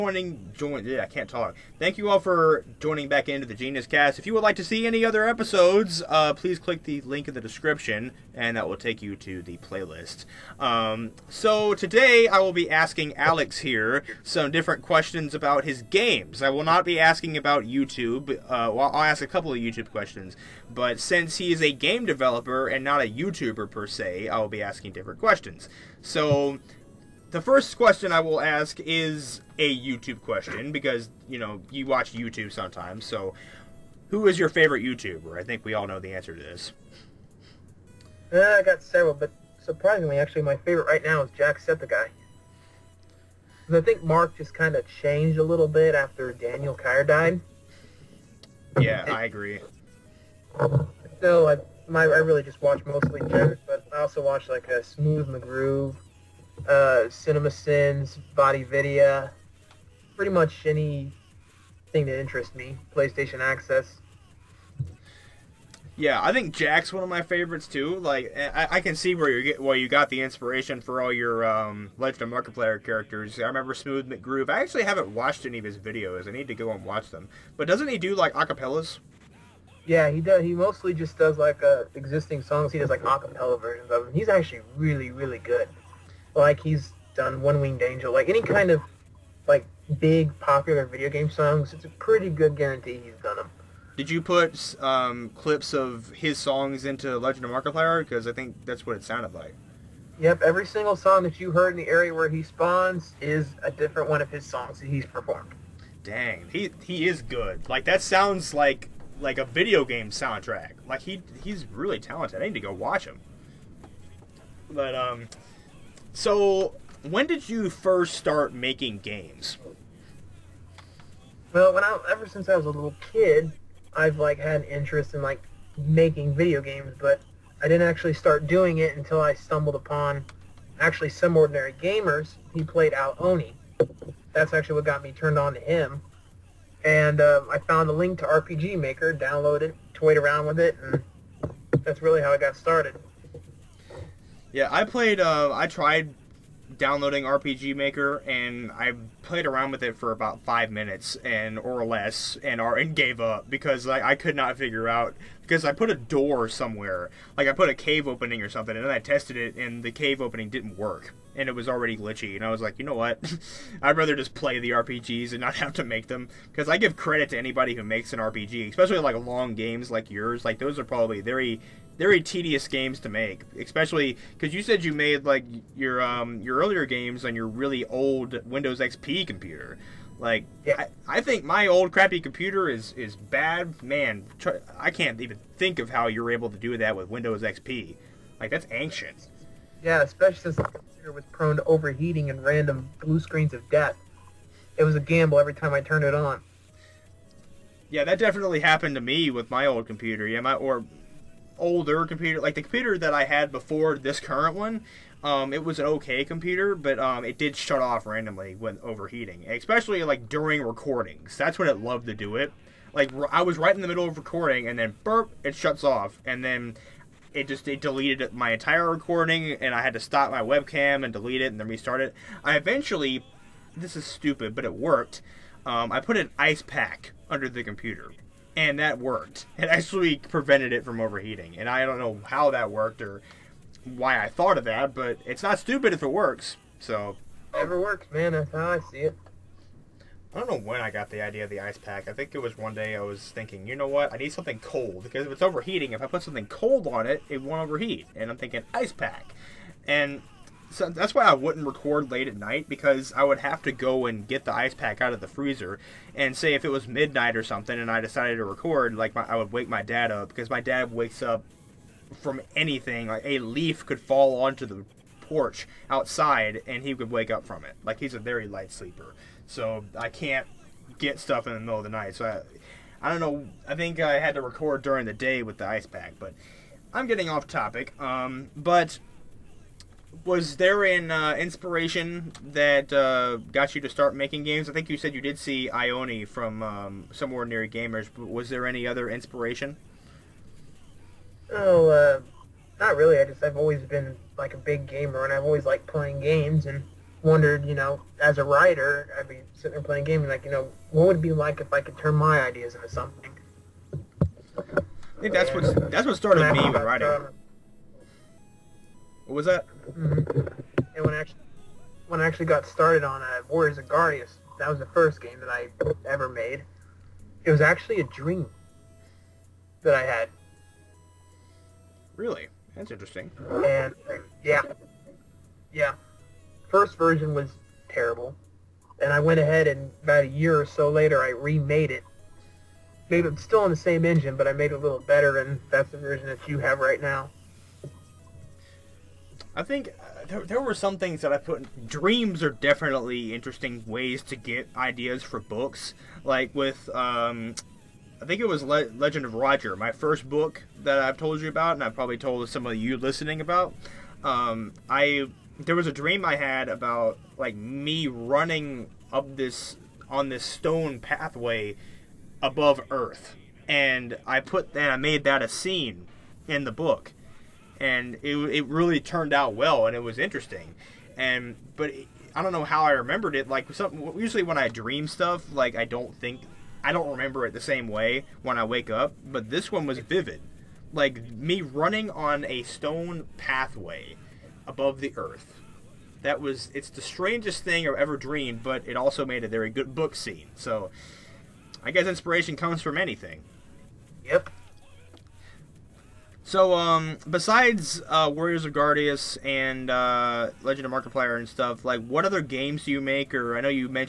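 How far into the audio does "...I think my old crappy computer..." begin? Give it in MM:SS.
03:01.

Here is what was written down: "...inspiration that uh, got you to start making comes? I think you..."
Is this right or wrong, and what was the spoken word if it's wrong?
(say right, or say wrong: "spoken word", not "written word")
wrong: "games", not "comes".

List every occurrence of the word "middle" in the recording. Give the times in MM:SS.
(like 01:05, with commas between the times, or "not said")
03:33, 04:31.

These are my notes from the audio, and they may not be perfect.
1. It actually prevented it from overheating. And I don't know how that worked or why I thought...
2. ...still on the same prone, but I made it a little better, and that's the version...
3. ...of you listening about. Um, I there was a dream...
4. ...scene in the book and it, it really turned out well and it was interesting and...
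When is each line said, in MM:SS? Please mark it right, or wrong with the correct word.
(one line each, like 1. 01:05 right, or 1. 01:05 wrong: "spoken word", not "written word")
1. 03:49 right
2. 05:33 wrong: "engine", not "prone"
3. 05:52 right
4. 06:05 right.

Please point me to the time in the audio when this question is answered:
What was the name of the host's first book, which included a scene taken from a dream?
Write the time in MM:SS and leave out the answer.
05:48.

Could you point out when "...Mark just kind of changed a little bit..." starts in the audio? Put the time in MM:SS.
00:44.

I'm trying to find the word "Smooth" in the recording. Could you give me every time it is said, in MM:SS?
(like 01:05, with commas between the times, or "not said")
00:54, 01:13.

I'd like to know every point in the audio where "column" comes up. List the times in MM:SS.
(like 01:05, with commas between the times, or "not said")
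not said.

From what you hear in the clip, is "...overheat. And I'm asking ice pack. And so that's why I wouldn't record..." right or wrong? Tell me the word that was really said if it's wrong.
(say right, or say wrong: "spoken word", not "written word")
wrong: "thinking", not "asking".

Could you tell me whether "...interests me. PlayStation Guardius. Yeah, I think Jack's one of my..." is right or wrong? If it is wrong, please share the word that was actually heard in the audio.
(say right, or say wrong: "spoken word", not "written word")
wrong: "Access", not "Guardius".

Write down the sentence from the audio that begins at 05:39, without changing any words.
I think uh, there, there were some things that I put.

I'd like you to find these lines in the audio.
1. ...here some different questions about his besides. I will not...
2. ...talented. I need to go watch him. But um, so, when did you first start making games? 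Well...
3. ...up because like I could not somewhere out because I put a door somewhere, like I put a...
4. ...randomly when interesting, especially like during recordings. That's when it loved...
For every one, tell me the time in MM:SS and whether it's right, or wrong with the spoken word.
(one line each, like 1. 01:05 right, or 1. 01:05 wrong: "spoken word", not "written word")
1. 00:13 wrong: "games", not "besides"
2. 01:51 right
3. 02:33 wrong: "figure", not "somewhere"
4. 03:28 wrong: "overheating", not "interesting".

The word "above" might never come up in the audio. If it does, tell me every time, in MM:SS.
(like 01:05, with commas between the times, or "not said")
06:02, 06:24.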